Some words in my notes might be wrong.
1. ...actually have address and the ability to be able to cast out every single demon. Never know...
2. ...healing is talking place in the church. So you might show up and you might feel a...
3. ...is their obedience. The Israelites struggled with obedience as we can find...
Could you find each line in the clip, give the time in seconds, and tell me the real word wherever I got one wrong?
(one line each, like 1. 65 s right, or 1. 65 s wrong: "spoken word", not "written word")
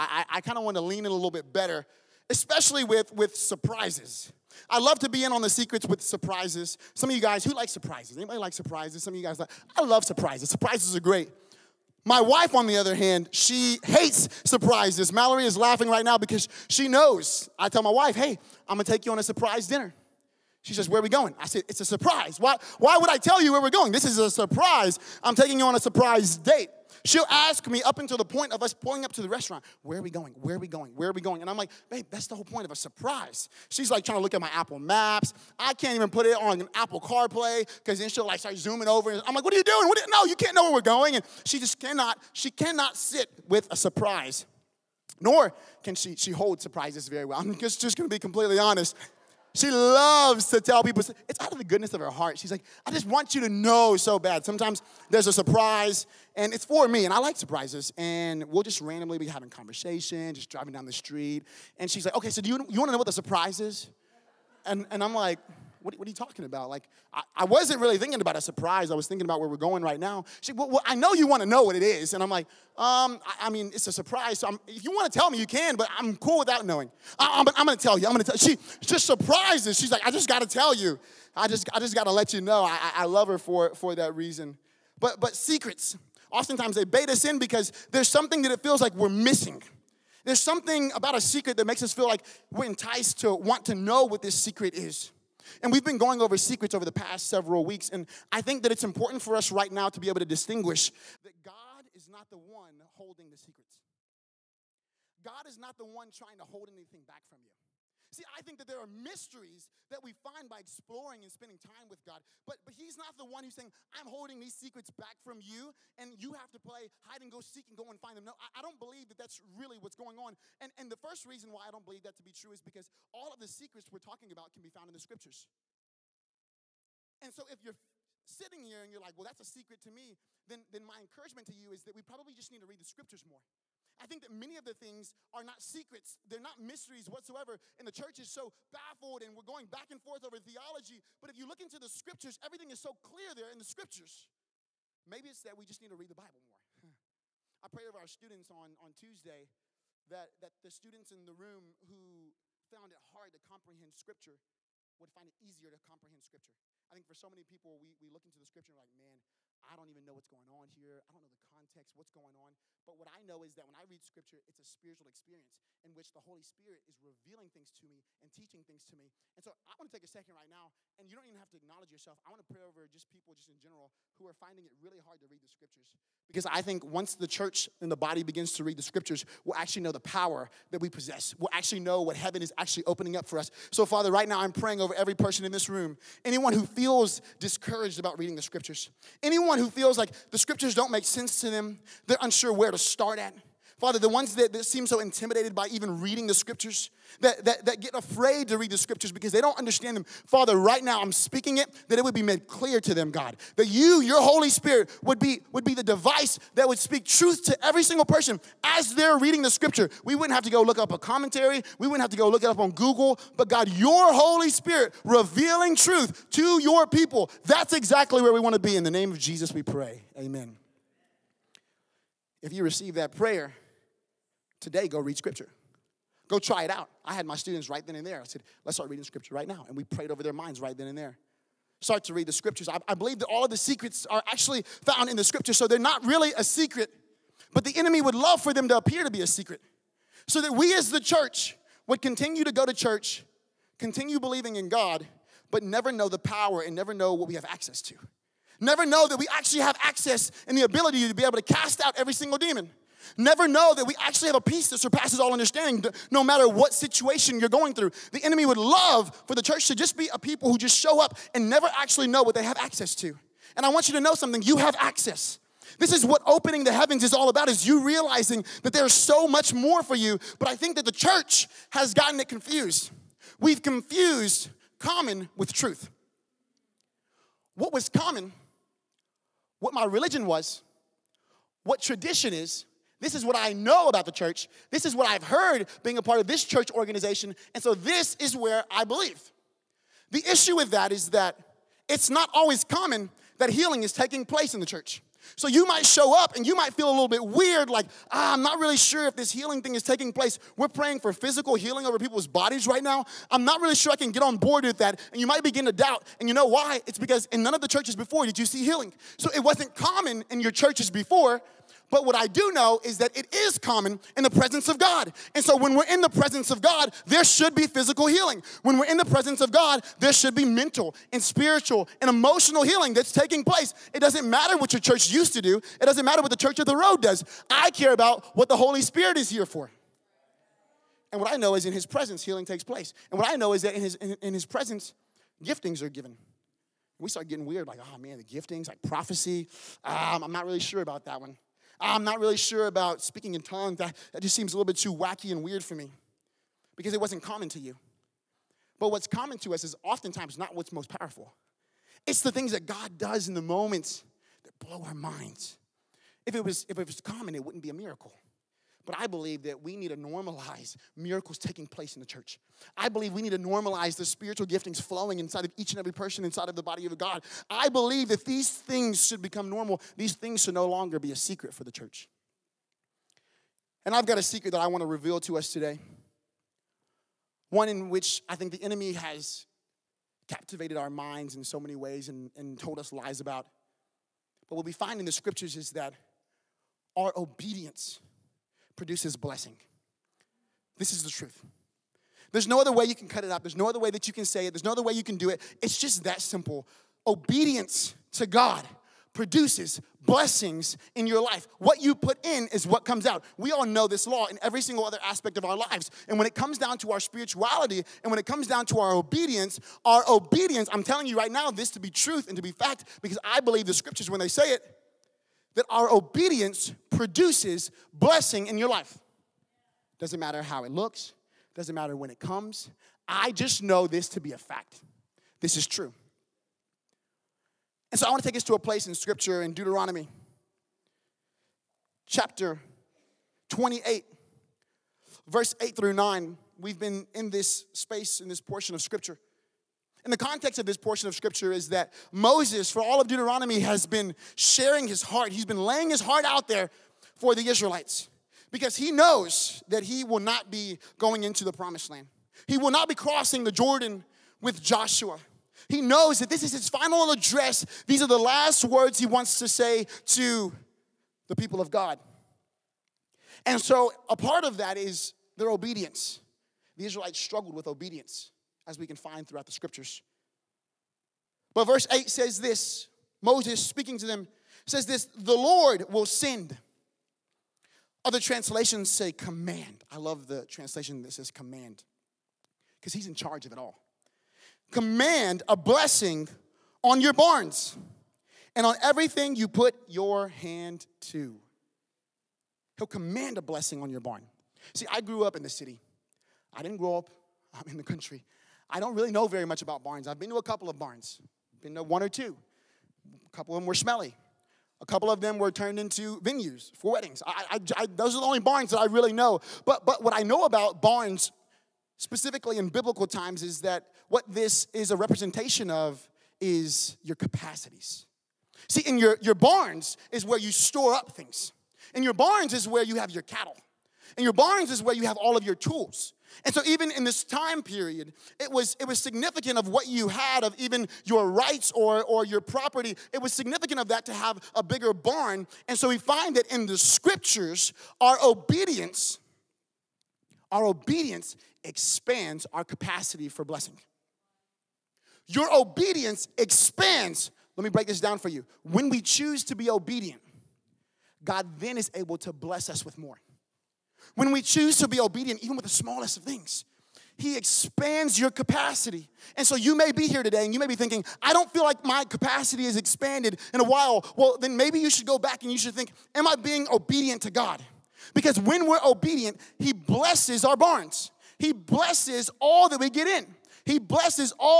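1. 249 s wrong: "access", not "address"
2. 293 s wrong: "taking", not "talking"
3. 464 s right.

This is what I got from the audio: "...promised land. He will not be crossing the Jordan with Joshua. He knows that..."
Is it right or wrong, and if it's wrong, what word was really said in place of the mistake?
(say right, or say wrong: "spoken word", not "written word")
right.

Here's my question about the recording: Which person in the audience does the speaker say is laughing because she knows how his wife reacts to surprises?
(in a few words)
Mallory.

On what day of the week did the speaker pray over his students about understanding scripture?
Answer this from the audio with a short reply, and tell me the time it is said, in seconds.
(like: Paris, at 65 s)
Tuesday, at 148 s.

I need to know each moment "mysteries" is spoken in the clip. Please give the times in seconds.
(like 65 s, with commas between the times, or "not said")
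108 s, 136 s.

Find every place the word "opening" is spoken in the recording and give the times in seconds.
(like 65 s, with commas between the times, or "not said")
182 s, 266 s.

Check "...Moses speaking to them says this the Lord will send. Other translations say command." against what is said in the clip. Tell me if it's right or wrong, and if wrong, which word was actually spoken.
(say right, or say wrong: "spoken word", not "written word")
right.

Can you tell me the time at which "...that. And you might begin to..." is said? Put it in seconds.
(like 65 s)
304 s.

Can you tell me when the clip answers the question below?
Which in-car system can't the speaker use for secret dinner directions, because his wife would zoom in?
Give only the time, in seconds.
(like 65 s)
36 s.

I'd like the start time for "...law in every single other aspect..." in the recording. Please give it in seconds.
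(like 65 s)
404 s.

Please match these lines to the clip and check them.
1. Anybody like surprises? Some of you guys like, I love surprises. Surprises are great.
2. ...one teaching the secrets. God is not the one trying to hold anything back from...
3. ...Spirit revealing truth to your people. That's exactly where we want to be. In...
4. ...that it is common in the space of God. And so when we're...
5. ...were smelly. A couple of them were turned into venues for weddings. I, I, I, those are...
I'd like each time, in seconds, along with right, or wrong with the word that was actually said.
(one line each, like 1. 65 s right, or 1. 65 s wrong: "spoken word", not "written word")
1. 8 s right
2. 102 s wrong: "holding", not "teaching"
3. 214 s right
4. 312 s wrong: "presence", not "space"
5. 503 s right.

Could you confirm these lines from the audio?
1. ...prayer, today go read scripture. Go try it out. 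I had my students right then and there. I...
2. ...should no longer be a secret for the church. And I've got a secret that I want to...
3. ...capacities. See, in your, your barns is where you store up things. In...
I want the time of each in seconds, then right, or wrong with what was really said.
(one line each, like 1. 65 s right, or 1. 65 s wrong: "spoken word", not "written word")
1. 223 s right
2. 370 s right
3. 517 s right.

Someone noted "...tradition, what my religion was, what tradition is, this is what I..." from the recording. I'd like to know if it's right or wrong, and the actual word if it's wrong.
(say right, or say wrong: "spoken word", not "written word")
wrong: "common", not "tradition".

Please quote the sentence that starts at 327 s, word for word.
I care about what the Holy Spirit is here for.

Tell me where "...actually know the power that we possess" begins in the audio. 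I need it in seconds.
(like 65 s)
179 s.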